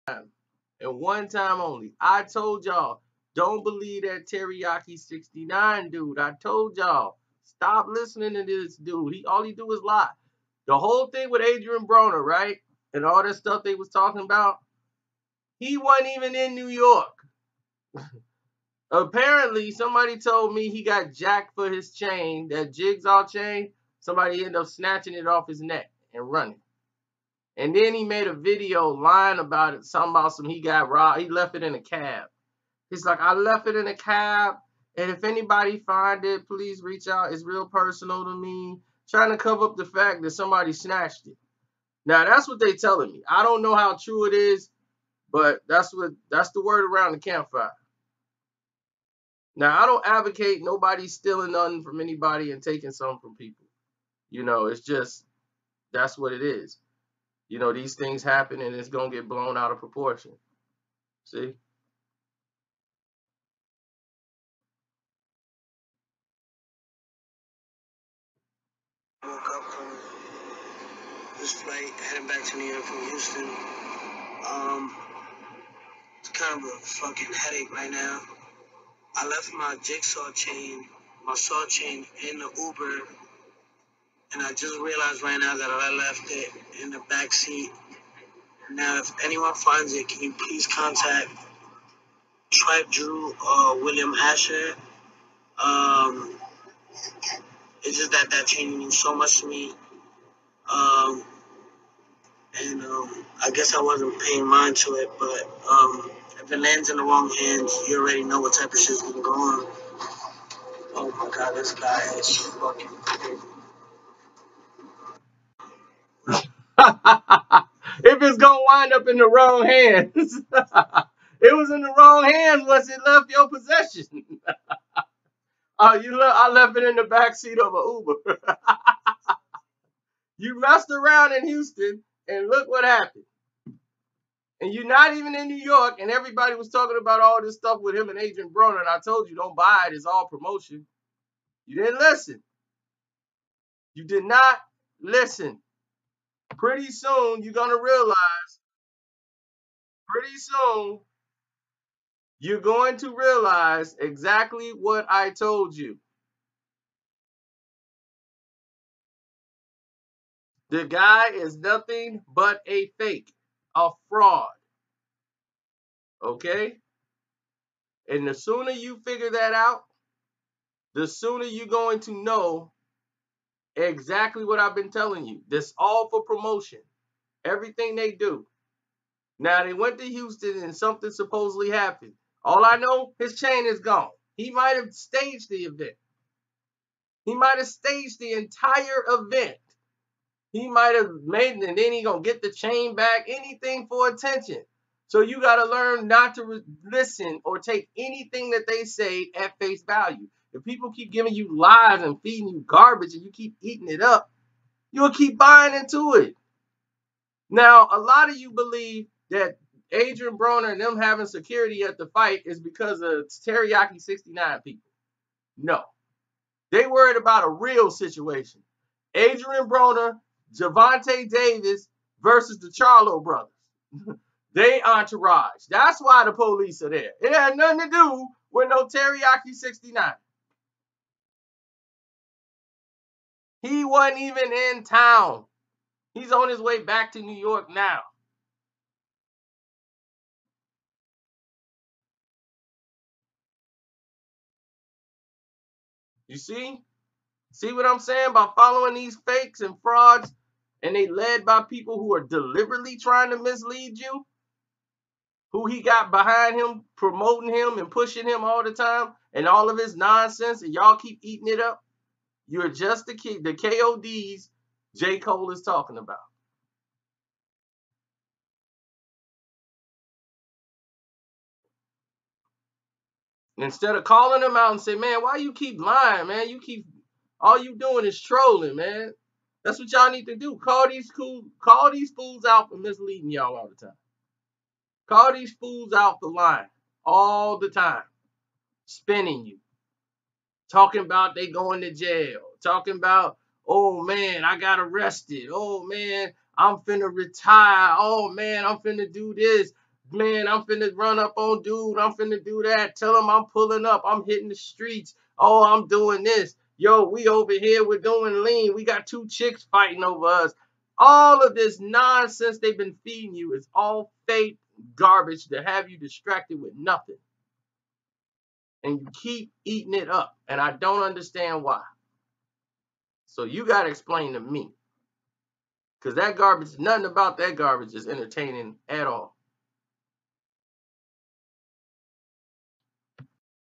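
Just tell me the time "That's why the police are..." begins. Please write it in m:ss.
3:45.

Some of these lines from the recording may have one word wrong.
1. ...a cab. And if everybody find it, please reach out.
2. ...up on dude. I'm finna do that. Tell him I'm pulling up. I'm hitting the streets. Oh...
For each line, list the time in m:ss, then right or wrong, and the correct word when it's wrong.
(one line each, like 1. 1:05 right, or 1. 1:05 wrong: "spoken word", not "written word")
1. 0:33 wrong: "anybody", not "everybody"
2. 5:01 right.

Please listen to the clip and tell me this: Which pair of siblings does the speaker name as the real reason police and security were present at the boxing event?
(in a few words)
the Charlo brothers.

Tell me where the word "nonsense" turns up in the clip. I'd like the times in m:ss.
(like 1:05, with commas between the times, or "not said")
4:19, 5:11.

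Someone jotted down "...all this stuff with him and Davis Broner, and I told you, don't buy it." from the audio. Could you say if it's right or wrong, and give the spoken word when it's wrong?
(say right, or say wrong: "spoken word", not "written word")
wrong: "Adrian", not "Davis".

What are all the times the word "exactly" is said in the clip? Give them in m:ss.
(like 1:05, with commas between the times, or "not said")
2:33, 2:53.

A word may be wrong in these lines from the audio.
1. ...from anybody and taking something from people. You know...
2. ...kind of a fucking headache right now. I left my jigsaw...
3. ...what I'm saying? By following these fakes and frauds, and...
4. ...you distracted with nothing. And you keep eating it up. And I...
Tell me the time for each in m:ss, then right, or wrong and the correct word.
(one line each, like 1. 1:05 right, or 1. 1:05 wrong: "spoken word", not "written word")
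1. 0:51 right
2. 1:16 right
3. 4:07 right
4. 5:15 right.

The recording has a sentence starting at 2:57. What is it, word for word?
Everything they do, now they went to Houston and something supposedly happened.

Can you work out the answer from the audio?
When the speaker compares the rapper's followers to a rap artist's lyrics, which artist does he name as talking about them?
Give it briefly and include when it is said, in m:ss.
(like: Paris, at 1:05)
J. Cole, at 4:24.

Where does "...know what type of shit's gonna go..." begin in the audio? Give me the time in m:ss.
1:48.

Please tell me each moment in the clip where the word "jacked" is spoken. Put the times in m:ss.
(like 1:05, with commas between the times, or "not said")
0:21.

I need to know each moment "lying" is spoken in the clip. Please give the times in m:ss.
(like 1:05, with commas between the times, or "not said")
0:28, 4:35, 4:46.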